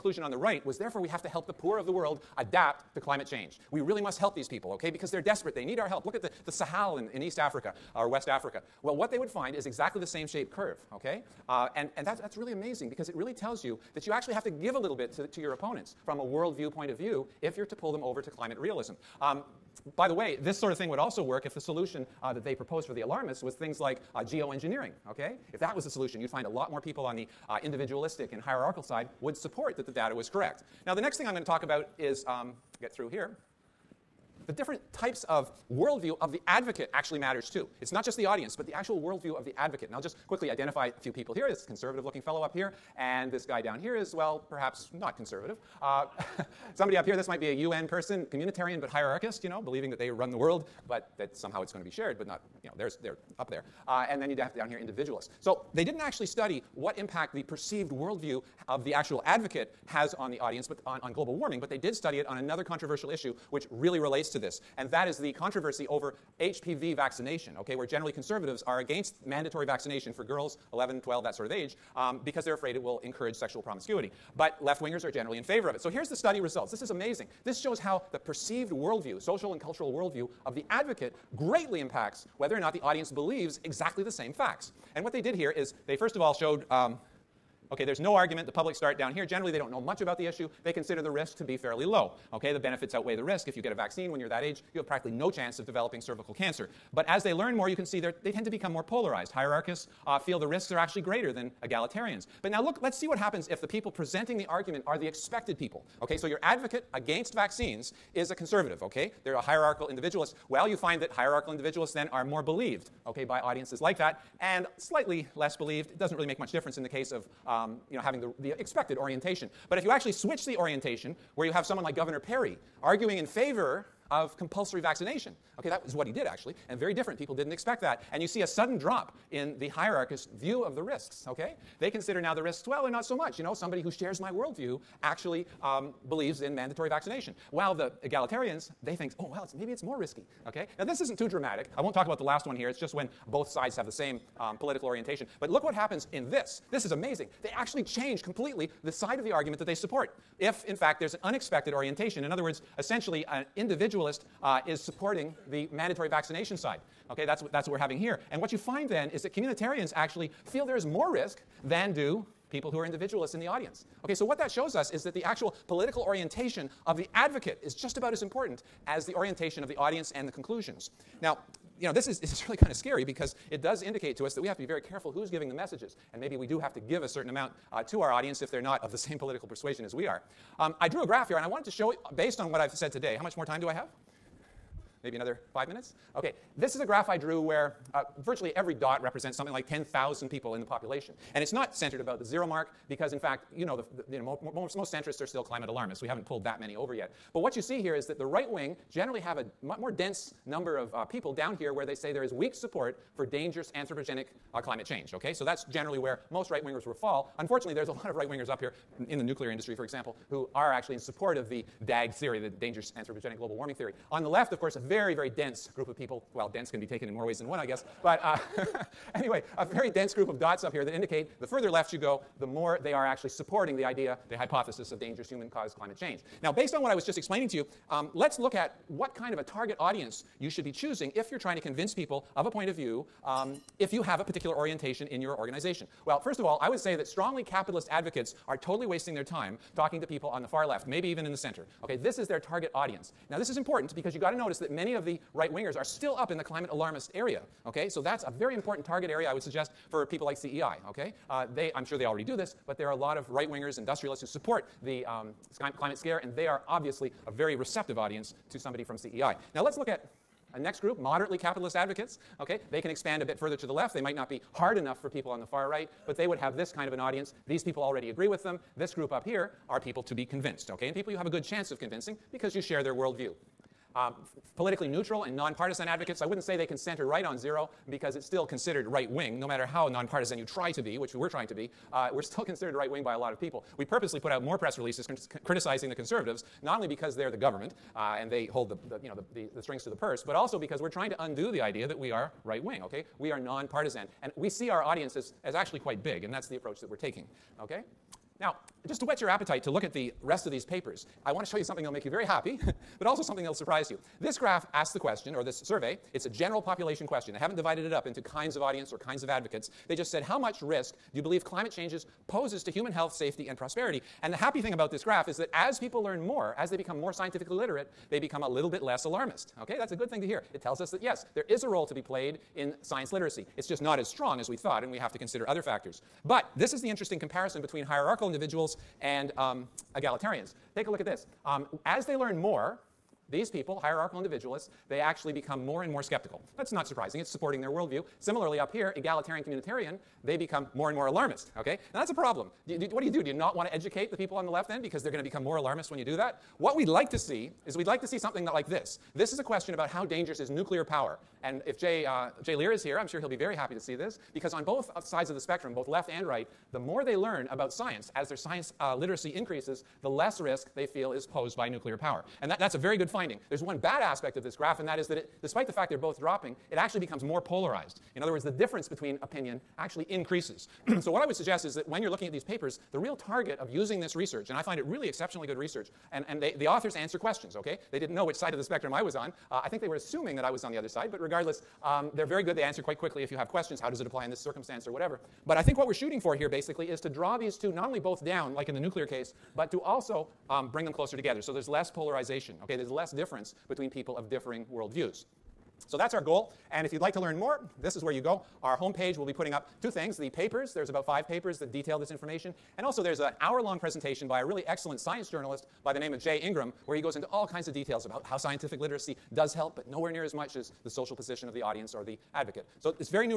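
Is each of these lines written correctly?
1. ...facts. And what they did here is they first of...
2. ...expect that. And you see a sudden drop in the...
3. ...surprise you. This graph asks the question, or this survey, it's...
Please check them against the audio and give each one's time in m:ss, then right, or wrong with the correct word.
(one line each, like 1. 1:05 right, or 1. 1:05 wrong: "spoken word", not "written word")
1. 1:24 right
2. 2:07 right
3. 5:03 right.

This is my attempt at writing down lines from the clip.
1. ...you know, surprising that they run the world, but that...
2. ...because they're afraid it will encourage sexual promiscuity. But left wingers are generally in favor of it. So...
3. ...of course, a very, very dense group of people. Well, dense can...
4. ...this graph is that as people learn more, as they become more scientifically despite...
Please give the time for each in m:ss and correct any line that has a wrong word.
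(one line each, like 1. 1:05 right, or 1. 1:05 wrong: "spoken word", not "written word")
1. 0:49 wrong: "believing", not "surprising"
2. 1:12 right
3. 3:34 right
4. 5:14 wrong: "literate", not "despite".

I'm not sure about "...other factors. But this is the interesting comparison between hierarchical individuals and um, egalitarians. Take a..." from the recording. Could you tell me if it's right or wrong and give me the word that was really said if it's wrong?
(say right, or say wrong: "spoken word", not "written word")
right.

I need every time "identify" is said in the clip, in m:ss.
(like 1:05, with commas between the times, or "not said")
0:40.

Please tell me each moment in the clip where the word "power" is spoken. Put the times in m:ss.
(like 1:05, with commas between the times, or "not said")
5:50, 6:01.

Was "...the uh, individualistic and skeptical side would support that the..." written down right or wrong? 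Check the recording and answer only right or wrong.
wrong.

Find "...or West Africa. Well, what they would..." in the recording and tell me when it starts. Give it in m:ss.
0:07.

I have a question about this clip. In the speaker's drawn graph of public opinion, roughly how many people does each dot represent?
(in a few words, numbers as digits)
10,000.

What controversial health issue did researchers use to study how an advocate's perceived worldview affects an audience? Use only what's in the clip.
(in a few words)
HPV vaccination.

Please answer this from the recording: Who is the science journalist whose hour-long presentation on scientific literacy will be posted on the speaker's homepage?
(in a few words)
Jay Ingram.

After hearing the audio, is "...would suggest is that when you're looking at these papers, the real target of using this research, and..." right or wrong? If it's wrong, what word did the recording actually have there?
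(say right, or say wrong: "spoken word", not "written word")
right.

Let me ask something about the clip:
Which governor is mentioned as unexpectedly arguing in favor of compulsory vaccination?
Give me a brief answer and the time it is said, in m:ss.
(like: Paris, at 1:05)
Governor Perry, at 2:01.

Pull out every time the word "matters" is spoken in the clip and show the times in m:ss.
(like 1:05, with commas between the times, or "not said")
0:37, 4:39.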